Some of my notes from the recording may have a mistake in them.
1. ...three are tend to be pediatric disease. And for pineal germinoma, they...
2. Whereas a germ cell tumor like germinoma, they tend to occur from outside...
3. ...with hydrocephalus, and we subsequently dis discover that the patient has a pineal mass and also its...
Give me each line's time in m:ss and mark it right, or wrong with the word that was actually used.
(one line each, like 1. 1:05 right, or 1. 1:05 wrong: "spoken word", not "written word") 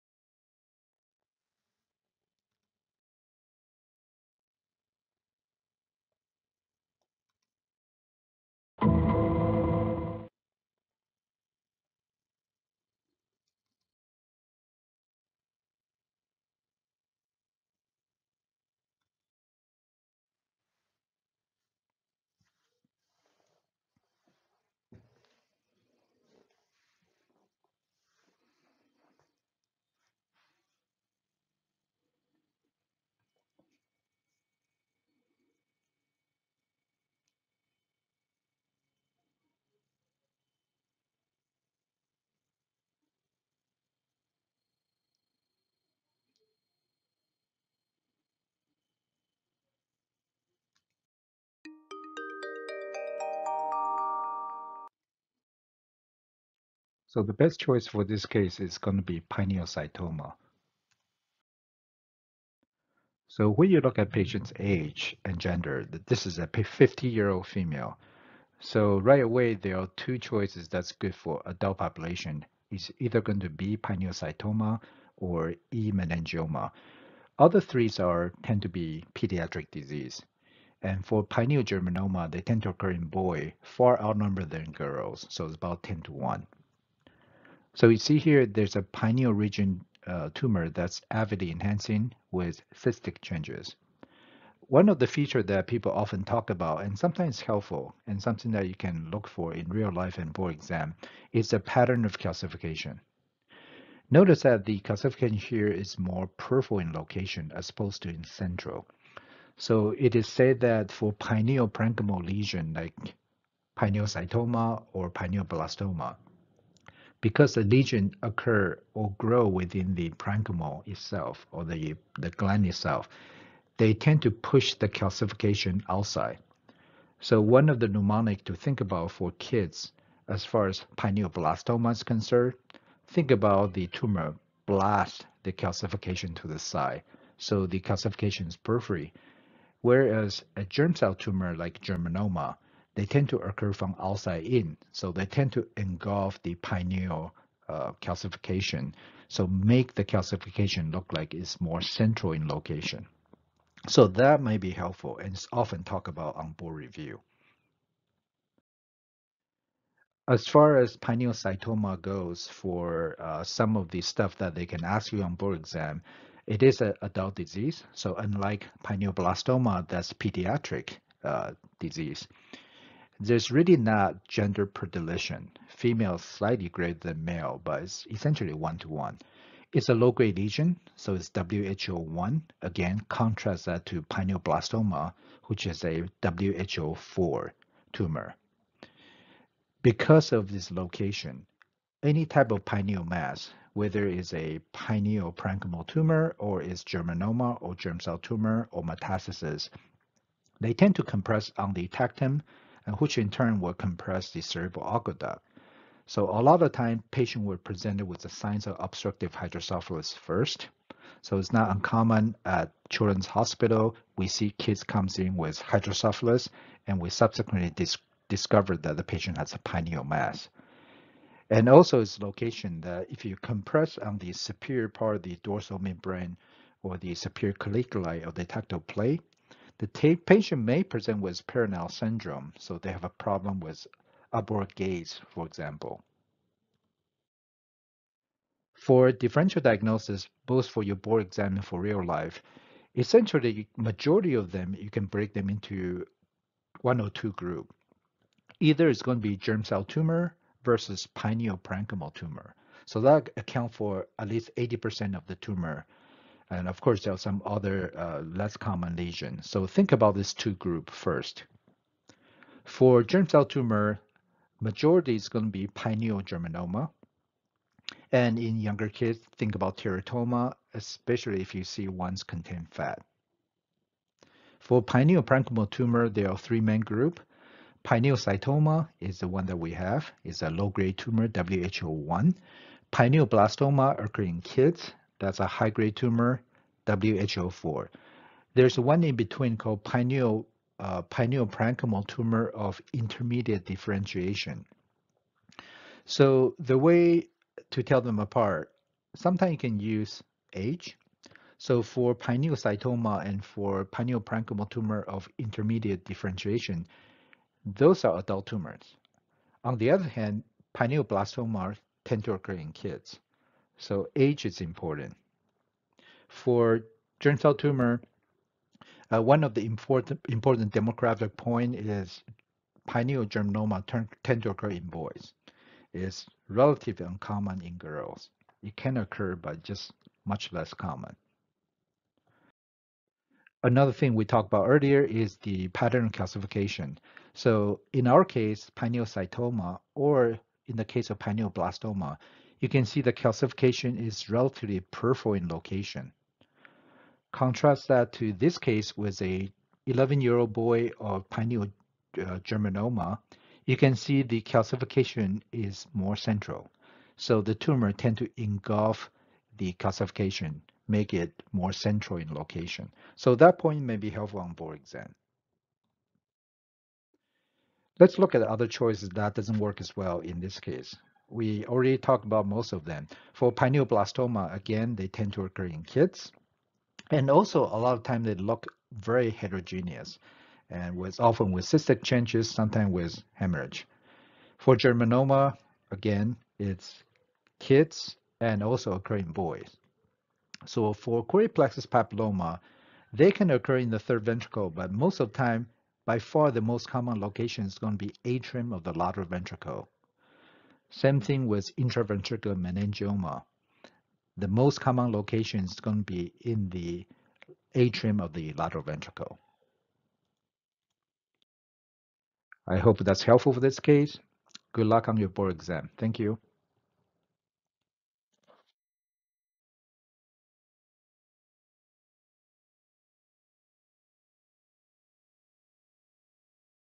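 1. 1:17 right
2. 2:19 right
3. 3:35 right.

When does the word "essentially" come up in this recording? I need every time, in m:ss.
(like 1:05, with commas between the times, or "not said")
2:58, 4:02.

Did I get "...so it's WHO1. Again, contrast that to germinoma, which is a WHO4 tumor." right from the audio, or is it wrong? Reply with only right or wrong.
wrong.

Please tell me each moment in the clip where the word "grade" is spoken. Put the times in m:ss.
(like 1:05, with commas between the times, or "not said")
2:59, 4:40.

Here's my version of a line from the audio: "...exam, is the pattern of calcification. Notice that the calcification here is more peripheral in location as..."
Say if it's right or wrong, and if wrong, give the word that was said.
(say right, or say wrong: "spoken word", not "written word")
right.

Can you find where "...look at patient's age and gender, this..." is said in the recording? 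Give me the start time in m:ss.
1:03.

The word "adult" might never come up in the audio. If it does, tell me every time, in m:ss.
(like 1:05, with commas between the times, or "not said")
1:11, 2:47.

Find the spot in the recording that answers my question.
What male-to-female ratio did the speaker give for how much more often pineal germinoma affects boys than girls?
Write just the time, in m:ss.
1:25.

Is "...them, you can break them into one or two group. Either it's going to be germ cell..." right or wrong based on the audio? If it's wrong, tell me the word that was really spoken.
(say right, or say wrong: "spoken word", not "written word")
right.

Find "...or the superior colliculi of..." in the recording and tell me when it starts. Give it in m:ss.
3:46.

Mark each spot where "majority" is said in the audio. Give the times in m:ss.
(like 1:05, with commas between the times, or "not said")
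4:03, 4:24.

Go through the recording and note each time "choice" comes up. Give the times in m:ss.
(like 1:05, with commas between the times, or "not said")
0:57, 1:10.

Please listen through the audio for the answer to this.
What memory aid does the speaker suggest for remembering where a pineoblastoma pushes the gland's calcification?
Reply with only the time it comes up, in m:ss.
2:14.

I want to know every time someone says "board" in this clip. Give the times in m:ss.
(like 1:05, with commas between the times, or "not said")
1:40, 2:36, 2:45, 4:00.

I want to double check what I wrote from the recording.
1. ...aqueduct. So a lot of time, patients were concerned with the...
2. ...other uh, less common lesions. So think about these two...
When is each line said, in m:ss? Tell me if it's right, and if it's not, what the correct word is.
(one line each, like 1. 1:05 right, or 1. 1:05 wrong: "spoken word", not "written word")
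1. 3:24 wrong: "presented", not "concerned"
2. 4:17 right.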